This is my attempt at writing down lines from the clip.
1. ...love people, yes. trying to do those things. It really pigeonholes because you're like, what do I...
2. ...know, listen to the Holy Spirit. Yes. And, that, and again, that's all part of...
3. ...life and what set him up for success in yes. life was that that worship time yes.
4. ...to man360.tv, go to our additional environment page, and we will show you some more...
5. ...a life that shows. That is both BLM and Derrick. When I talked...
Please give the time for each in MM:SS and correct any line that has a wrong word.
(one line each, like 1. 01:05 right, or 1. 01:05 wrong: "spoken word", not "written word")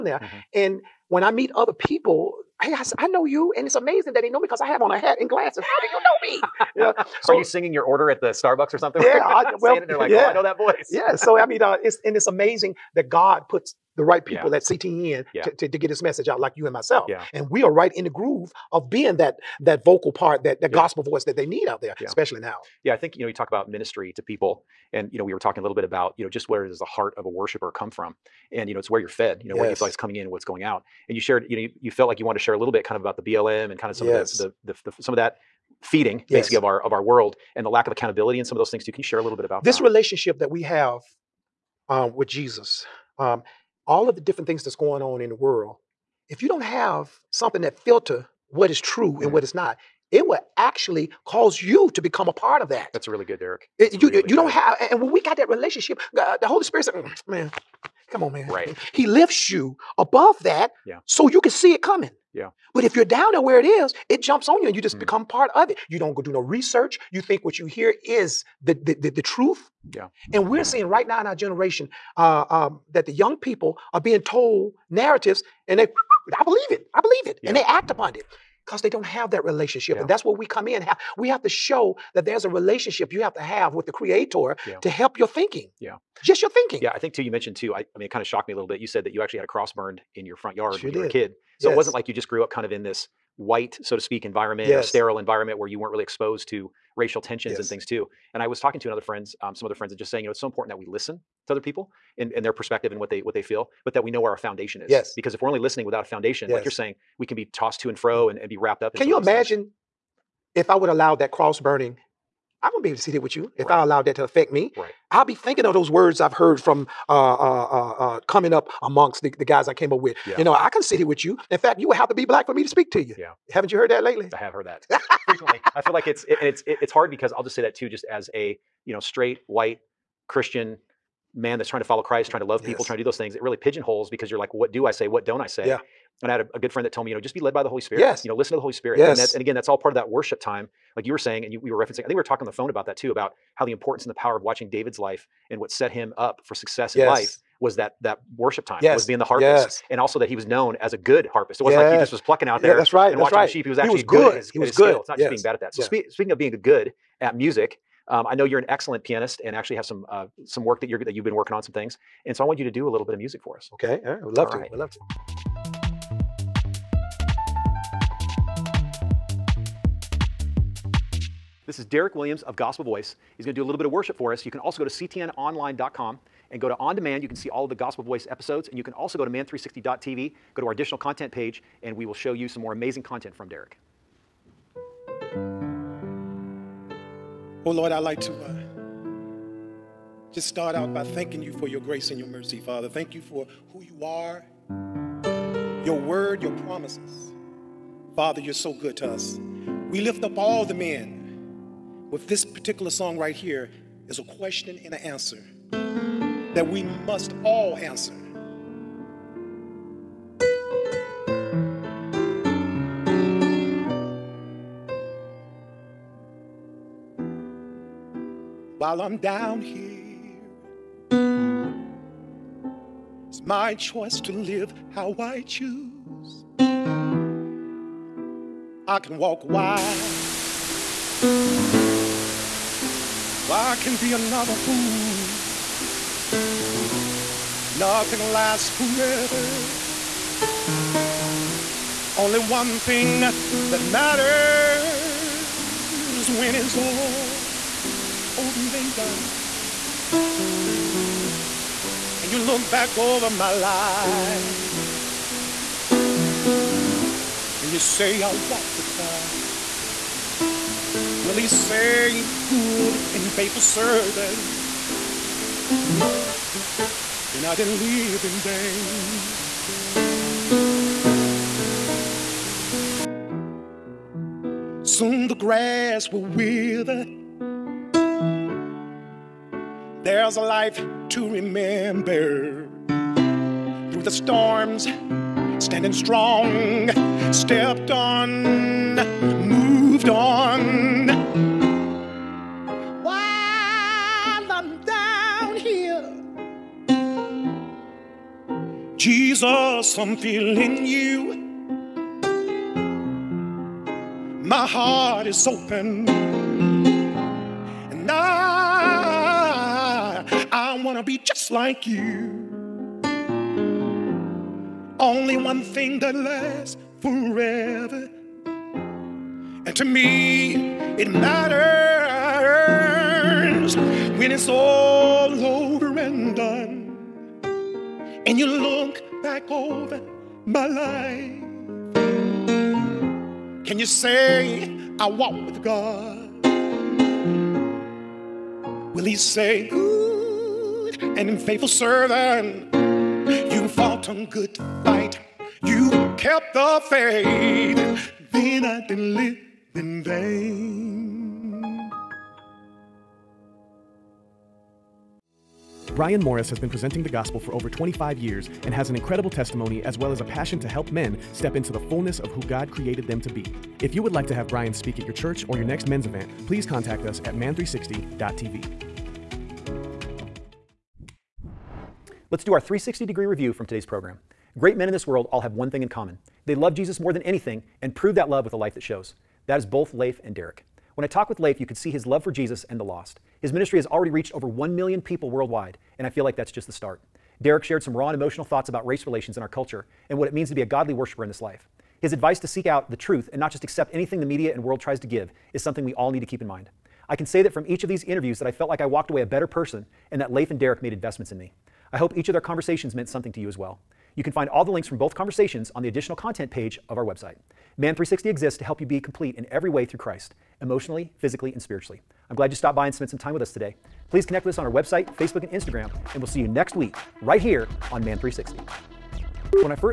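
1. 02:12 right
2. 02:18 right
3. 02:24 right
4. 02:59 wrong: "content", not "environment"
5. 06:18 wrong: "Leif", not "BLM".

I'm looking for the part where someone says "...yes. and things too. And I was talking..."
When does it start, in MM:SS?
01:37.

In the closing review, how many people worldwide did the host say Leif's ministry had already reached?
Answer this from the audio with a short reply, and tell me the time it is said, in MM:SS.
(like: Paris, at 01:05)
over 1 million, at 06:24.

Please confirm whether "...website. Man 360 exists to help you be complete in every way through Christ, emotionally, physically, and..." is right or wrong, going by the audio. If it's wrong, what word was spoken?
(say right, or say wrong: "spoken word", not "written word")
right.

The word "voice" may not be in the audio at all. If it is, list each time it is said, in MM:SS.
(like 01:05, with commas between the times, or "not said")
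00:10, 00:21, 02:52, 02:58.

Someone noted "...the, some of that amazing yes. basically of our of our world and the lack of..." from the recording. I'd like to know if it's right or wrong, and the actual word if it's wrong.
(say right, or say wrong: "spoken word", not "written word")
wrong: "feeding", not "amazing".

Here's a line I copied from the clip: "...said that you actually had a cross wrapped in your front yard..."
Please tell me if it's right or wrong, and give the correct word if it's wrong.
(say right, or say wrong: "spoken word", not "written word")
wrong: "burned", not "wrapped".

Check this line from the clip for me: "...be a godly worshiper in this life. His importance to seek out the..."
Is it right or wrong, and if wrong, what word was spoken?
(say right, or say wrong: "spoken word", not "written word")
wrong: "advice", not "importance".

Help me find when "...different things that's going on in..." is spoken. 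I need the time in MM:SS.
00:44.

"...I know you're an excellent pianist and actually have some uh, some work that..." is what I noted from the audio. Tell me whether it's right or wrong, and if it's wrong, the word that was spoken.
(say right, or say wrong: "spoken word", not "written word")
right.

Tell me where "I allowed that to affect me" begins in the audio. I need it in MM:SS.
01:53.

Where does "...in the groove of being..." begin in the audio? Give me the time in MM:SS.
00:17.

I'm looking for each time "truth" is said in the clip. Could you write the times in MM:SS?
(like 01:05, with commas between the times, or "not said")
01:09, 06:32.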